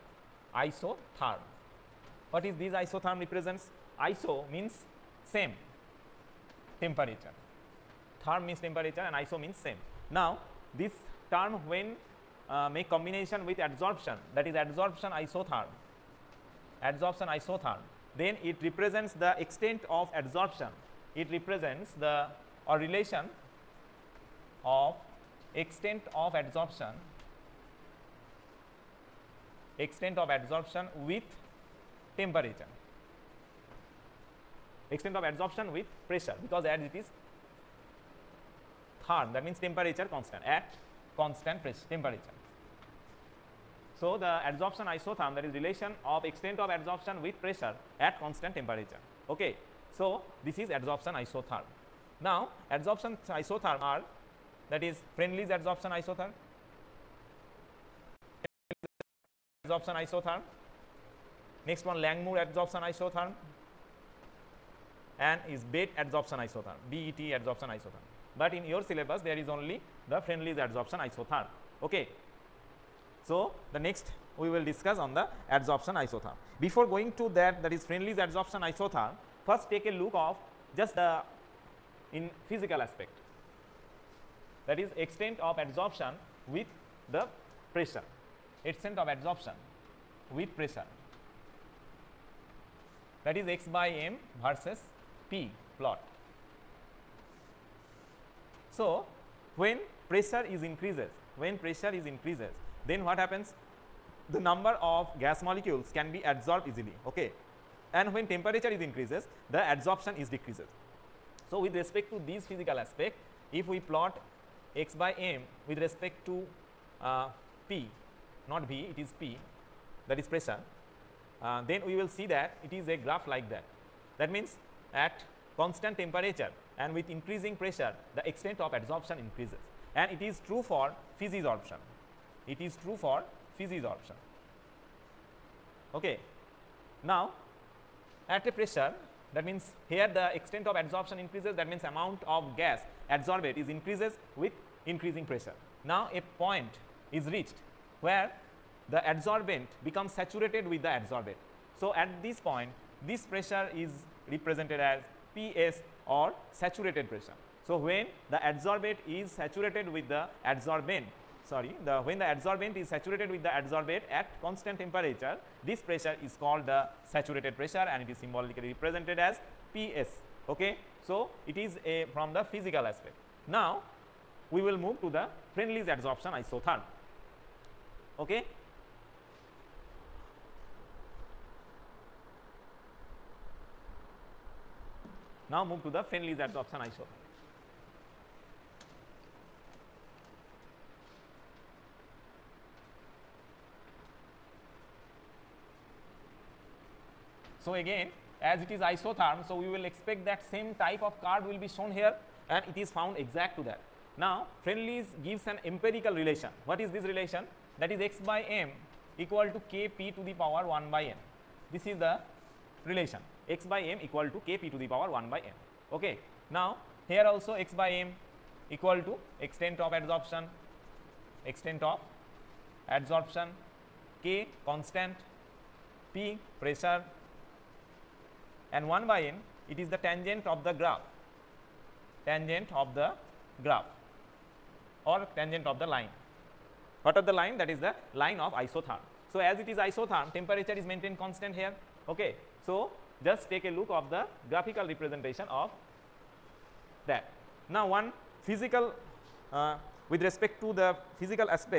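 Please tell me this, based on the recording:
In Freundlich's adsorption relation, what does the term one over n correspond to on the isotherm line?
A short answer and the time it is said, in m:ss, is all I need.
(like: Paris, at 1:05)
tangent of the line, at 3:55.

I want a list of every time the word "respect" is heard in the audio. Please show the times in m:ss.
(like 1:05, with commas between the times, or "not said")
1:51, 1:55, 4:10.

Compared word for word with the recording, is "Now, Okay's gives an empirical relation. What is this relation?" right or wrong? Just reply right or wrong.
wrong.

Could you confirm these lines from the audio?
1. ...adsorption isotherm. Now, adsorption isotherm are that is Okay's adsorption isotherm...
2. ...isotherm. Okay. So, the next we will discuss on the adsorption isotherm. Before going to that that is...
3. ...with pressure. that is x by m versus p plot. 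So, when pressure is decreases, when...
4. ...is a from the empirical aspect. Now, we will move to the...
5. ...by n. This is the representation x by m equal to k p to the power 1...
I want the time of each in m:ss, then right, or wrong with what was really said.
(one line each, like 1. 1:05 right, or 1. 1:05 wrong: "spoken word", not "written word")
1. 0:50 wrong: "Freundlich", not "Okay"
2. 1:11 right
3. 1:30 wrong: "increases", not "decreases"
4. 2:51 wrong: "physical", not "empirical"
5. 3:30 wrong: "relation", not "representation".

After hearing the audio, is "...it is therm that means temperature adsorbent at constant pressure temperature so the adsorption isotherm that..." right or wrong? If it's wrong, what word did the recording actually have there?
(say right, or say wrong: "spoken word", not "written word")
wrong: "constant", not "adsorbent".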